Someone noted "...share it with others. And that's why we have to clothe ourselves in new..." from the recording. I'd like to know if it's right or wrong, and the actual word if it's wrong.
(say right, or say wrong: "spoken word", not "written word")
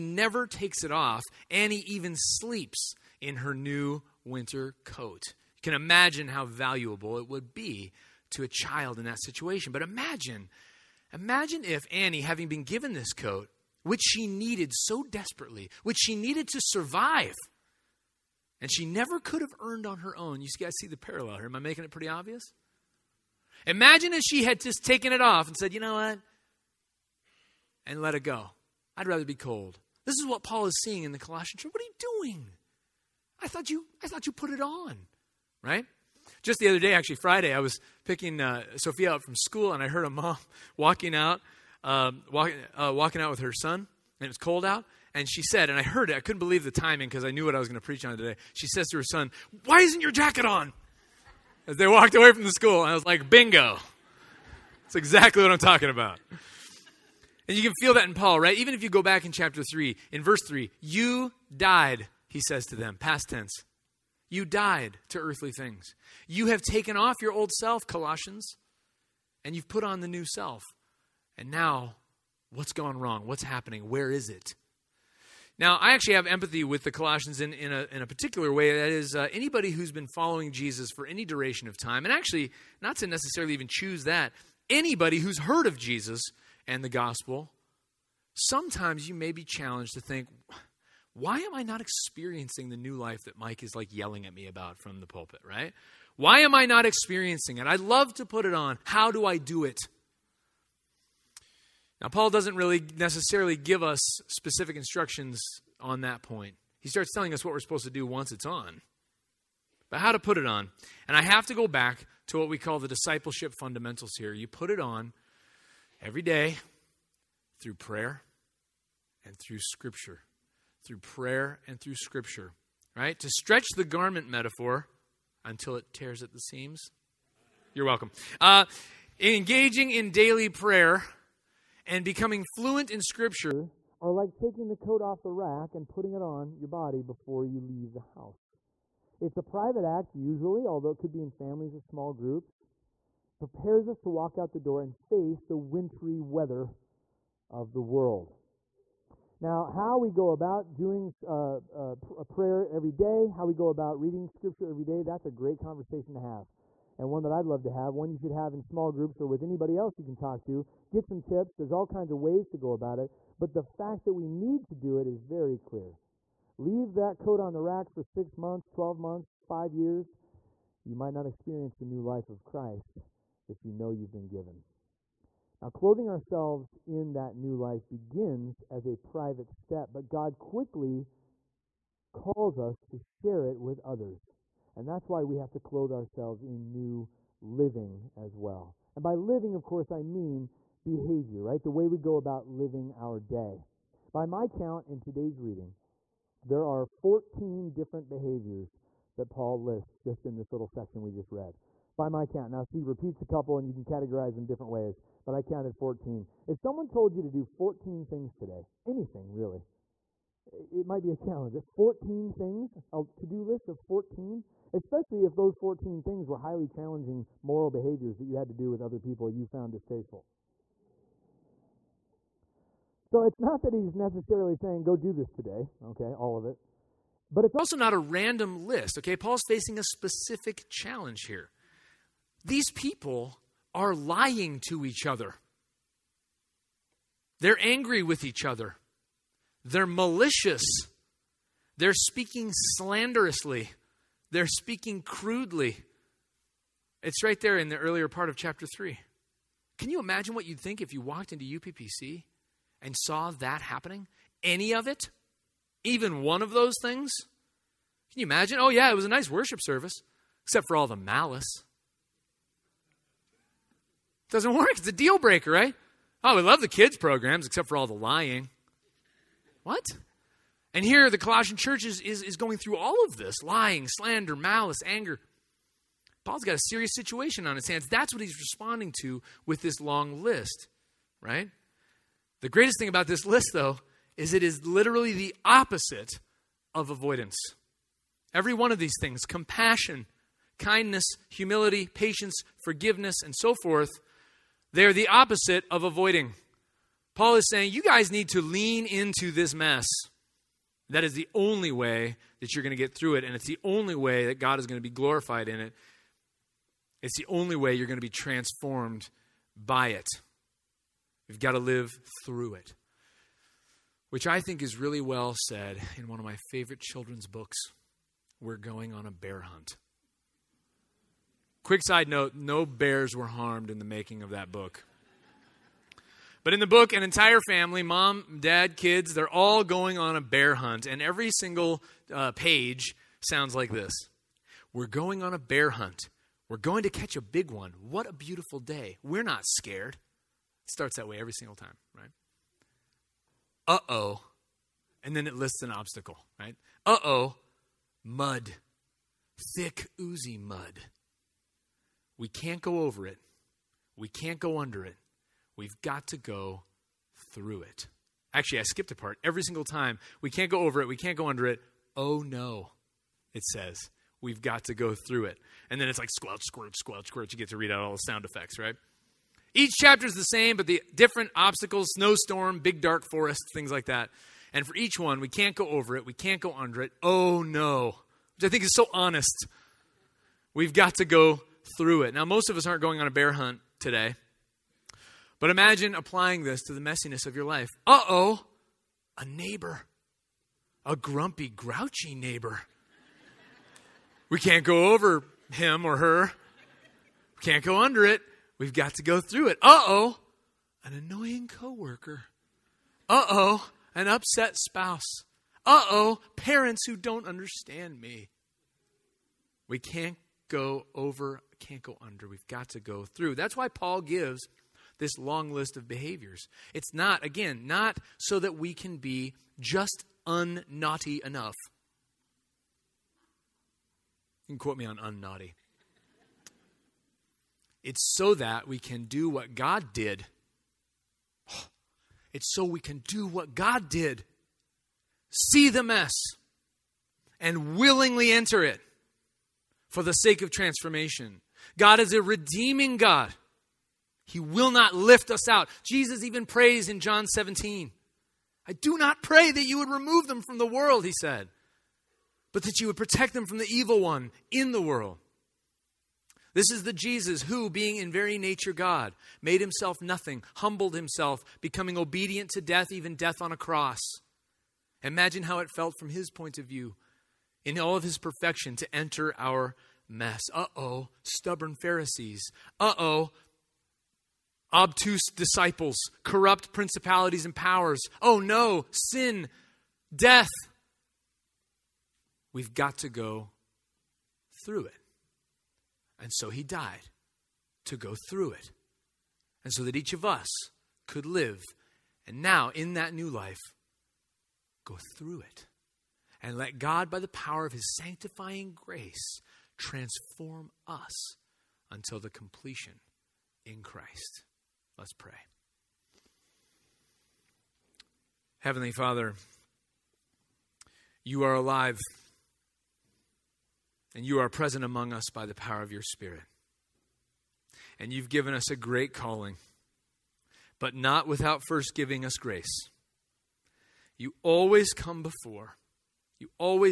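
right.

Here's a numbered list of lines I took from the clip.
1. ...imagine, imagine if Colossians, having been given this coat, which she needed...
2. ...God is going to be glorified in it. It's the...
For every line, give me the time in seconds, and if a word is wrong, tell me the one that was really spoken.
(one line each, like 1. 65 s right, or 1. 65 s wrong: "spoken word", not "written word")
1. 9 s wrong: "Annie", not "Colossians"
2. 304 s right.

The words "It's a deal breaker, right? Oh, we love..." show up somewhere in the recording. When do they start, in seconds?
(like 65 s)
264 s.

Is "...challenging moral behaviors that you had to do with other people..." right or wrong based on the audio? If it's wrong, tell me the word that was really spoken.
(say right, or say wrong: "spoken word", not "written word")
right.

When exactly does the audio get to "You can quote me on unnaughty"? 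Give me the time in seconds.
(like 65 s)
424 s.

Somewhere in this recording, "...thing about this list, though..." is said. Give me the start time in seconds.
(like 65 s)
282 s.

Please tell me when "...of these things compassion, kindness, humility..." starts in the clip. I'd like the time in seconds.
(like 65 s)
288 s.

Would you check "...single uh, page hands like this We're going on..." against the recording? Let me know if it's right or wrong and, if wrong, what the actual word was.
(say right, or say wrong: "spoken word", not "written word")
wrong: "sounds", not "hands".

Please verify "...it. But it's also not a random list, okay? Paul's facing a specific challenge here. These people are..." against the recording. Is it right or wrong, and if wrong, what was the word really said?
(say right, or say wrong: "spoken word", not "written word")
right.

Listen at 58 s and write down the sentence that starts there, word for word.
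Even if you go back in chapter 3, in verse 3, you died, he says to them, past tense.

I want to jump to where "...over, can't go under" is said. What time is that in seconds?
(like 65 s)
410 s.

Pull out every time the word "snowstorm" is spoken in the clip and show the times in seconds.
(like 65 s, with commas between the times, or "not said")
371 s.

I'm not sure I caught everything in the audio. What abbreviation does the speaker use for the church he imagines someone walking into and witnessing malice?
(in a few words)
UPPC.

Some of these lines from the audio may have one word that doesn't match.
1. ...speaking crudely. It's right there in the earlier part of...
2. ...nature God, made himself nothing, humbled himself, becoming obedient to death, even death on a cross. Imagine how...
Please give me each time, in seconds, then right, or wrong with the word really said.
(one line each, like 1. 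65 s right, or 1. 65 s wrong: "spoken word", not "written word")
1. 244 s right
2. 458 s right.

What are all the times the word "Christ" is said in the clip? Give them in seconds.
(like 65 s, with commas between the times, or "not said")
172 s, 503 s.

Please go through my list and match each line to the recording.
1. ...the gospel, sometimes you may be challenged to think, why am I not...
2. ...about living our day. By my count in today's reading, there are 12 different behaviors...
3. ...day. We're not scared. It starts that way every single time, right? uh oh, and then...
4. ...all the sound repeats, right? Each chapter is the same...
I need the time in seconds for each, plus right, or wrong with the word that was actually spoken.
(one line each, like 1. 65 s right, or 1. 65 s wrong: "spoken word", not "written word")
1. 86 s right
2. 192 s wrong: "14", not "12"
3. 338 s right
4. 367 s wrong: "effects", not "repeats".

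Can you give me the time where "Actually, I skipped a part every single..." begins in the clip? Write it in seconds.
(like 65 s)
358 s.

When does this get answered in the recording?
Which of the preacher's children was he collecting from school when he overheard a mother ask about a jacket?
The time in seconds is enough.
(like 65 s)
38 s.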